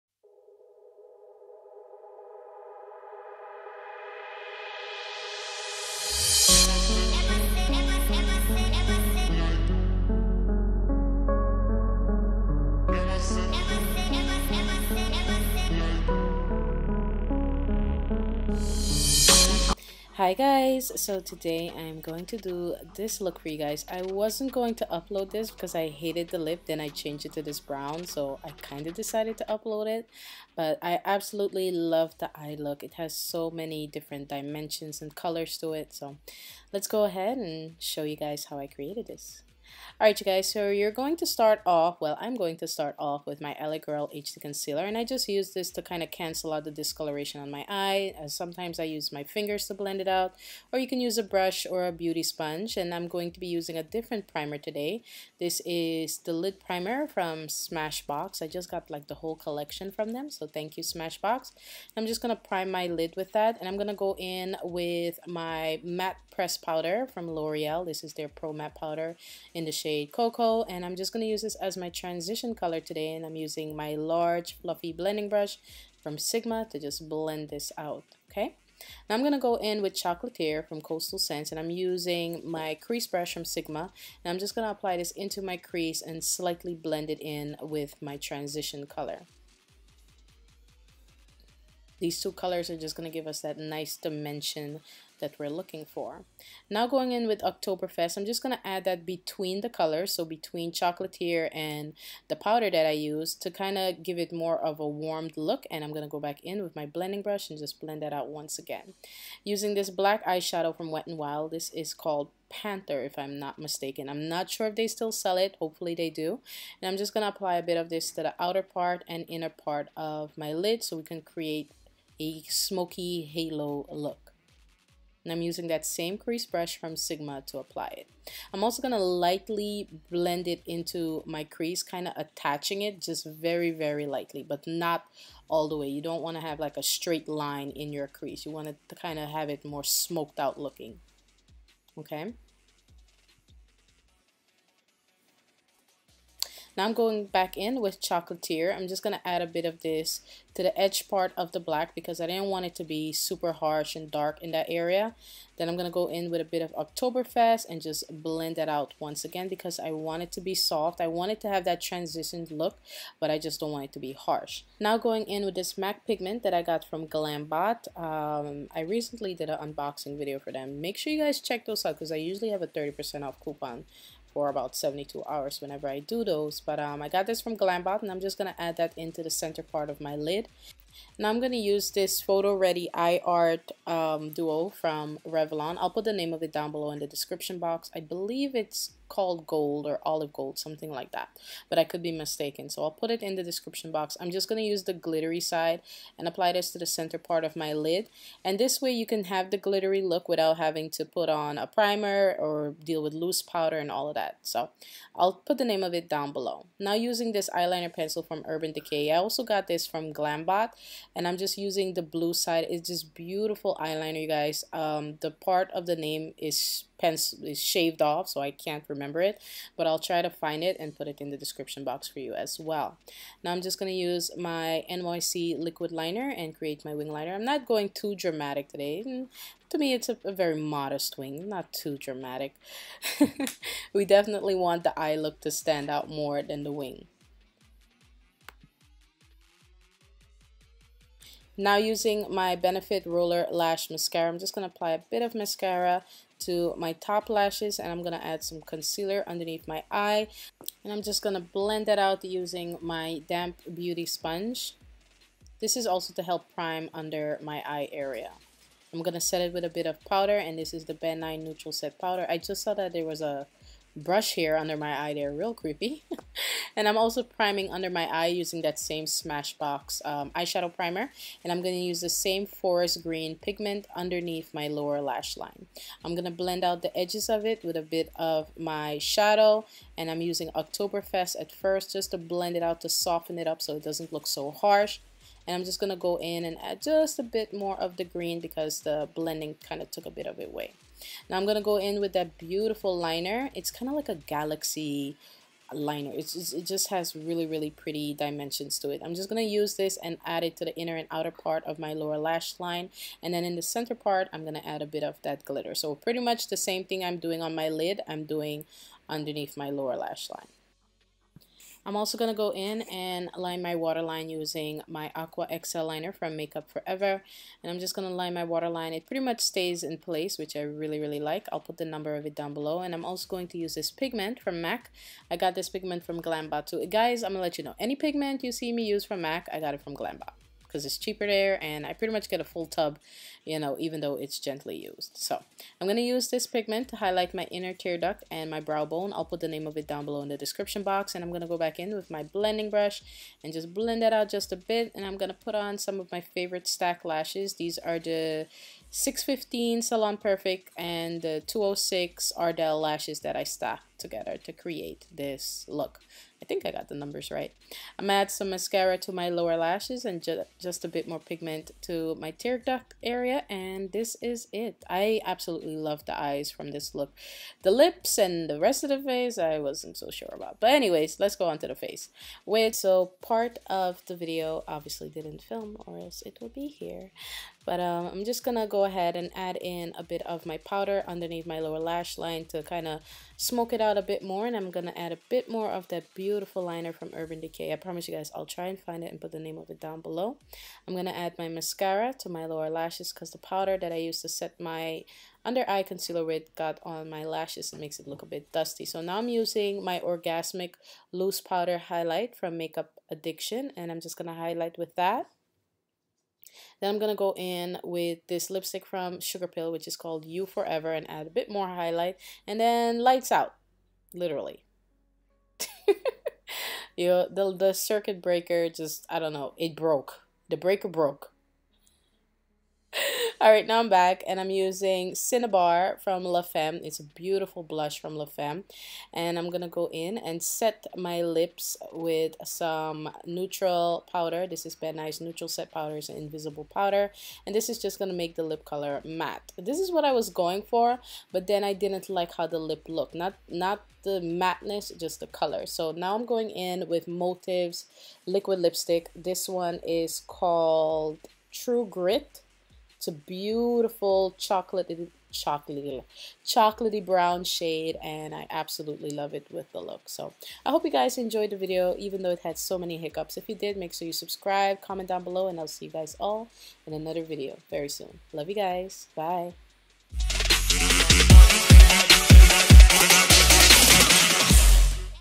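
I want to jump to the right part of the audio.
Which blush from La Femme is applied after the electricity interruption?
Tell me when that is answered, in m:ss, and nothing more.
7:05.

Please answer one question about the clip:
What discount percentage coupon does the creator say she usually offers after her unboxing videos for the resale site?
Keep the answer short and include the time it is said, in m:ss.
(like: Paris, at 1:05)
30%, at 2:52.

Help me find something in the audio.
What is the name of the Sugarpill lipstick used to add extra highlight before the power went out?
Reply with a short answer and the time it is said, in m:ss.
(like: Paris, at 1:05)
You Forever, at 6:49.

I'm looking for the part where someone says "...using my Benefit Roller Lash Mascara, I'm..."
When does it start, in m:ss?
4:01.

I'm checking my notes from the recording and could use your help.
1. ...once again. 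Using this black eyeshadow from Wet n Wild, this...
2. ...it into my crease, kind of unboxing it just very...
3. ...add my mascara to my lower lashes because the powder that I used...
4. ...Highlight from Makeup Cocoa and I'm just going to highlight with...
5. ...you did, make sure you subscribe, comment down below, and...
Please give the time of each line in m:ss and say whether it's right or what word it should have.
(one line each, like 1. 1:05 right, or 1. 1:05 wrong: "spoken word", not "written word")
1. 1:48 right
2. 2:10 wrong: "attaching", not "unboxing"
3. 6:31 right
4. 6:41 wrong: "Addiction", not "Cocoa"
5. 7:43 right.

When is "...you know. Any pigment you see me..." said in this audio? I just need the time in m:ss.
5:27.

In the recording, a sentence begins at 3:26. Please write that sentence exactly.
Now using this eyeliner pencil from Urban Decay.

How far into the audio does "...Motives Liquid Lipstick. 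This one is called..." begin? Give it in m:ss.
7:27.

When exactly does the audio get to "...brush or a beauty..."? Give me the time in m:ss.
0:51.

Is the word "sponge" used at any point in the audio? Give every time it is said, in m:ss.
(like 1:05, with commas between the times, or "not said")
0:52, 4:14.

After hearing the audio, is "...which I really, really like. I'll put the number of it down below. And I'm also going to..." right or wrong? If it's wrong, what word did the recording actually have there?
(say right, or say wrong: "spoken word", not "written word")
right.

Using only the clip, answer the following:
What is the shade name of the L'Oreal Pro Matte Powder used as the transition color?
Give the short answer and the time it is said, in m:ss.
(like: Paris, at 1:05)
Cocoa, at 1:09.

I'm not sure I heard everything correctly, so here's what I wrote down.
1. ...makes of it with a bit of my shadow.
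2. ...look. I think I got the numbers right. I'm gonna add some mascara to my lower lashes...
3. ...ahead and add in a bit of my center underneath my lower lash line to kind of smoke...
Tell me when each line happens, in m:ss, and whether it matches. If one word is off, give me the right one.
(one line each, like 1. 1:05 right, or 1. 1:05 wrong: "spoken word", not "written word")
1. 4:36 wrong: "edges", not "makes"
2. 5:55 right
3. 6:18 wrong: "powder", not "center".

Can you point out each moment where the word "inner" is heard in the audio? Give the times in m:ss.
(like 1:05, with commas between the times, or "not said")
1:59, 5:00, 5:37.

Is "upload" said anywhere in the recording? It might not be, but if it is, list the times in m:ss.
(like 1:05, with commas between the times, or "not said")
0:24, 0:29.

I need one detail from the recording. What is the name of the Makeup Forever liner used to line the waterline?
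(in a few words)
Aqua XL.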